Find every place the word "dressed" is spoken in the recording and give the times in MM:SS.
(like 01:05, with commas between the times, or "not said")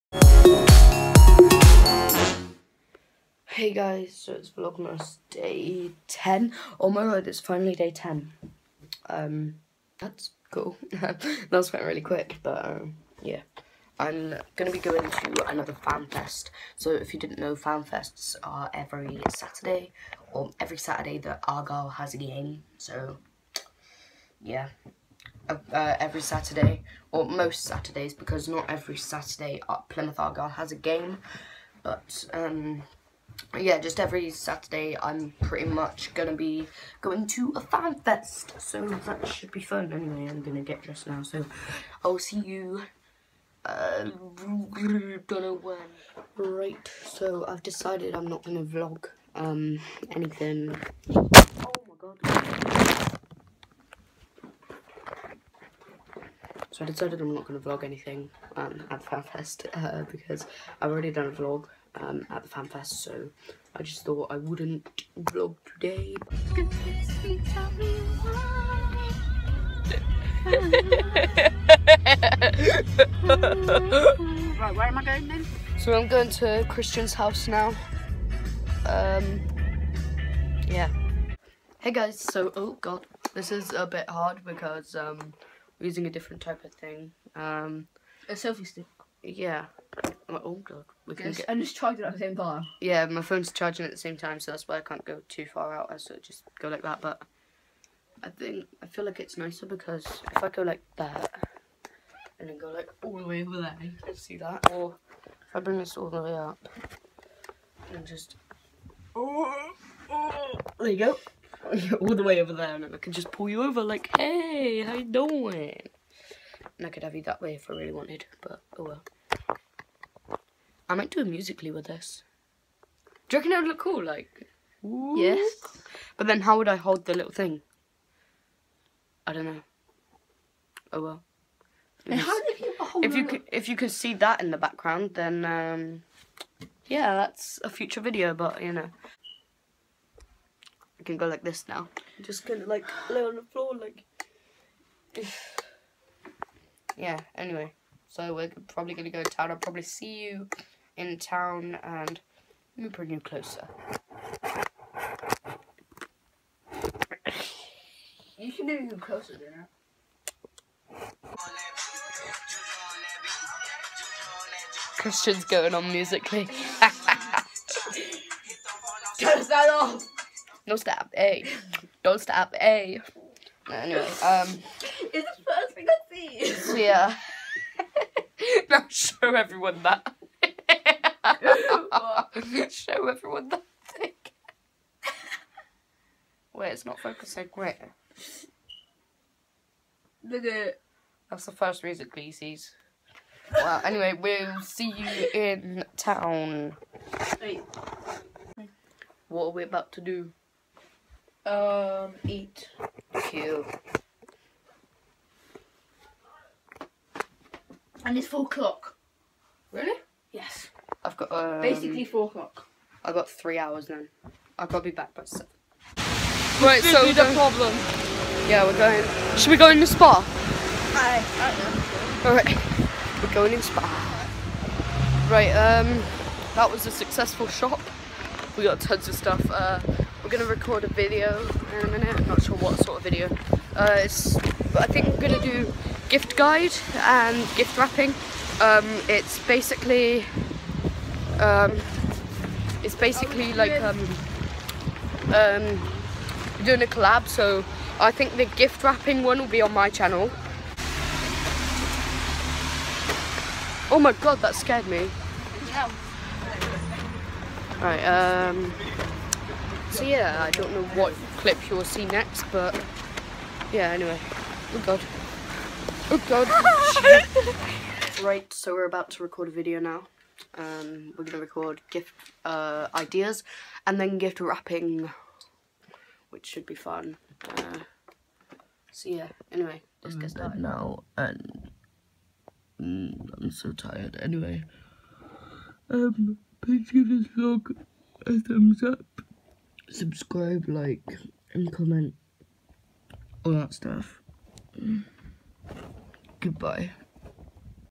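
00:40.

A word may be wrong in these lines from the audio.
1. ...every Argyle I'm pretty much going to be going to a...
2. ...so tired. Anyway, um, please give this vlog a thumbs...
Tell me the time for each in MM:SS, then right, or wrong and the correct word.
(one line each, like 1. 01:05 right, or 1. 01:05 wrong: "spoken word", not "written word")
1. 00:33 wrong: "Saturday", not "Argyle"
2. 04:43 right.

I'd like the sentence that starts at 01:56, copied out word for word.
And I could have you that way if I really wanted, but oh well.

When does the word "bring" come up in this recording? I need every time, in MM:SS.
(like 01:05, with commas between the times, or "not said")
01:45, 02:32, 02:38.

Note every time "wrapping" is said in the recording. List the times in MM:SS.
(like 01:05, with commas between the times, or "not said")
03:57, 04:08, 04:34.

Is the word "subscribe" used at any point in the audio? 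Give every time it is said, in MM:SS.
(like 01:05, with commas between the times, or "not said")
04:49.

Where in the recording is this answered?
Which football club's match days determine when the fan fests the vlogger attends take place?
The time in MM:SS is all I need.
00:29.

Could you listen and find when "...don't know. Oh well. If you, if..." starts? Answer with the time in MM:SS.
02:09.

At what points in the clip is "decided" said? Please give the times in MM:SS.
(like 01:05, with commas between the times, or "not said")
00:47, 00:56.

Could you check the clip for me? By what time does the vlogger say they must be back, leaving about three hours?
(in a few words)
7.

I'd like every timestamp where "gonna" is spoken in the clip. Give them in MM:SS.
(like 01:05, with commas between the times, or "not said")
03:50, 03:55, 04:31.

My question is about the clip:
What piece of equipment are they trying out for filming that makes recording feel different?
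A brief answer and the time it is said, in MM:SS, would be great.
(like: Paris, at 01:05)
A selfie stick, at 01:28.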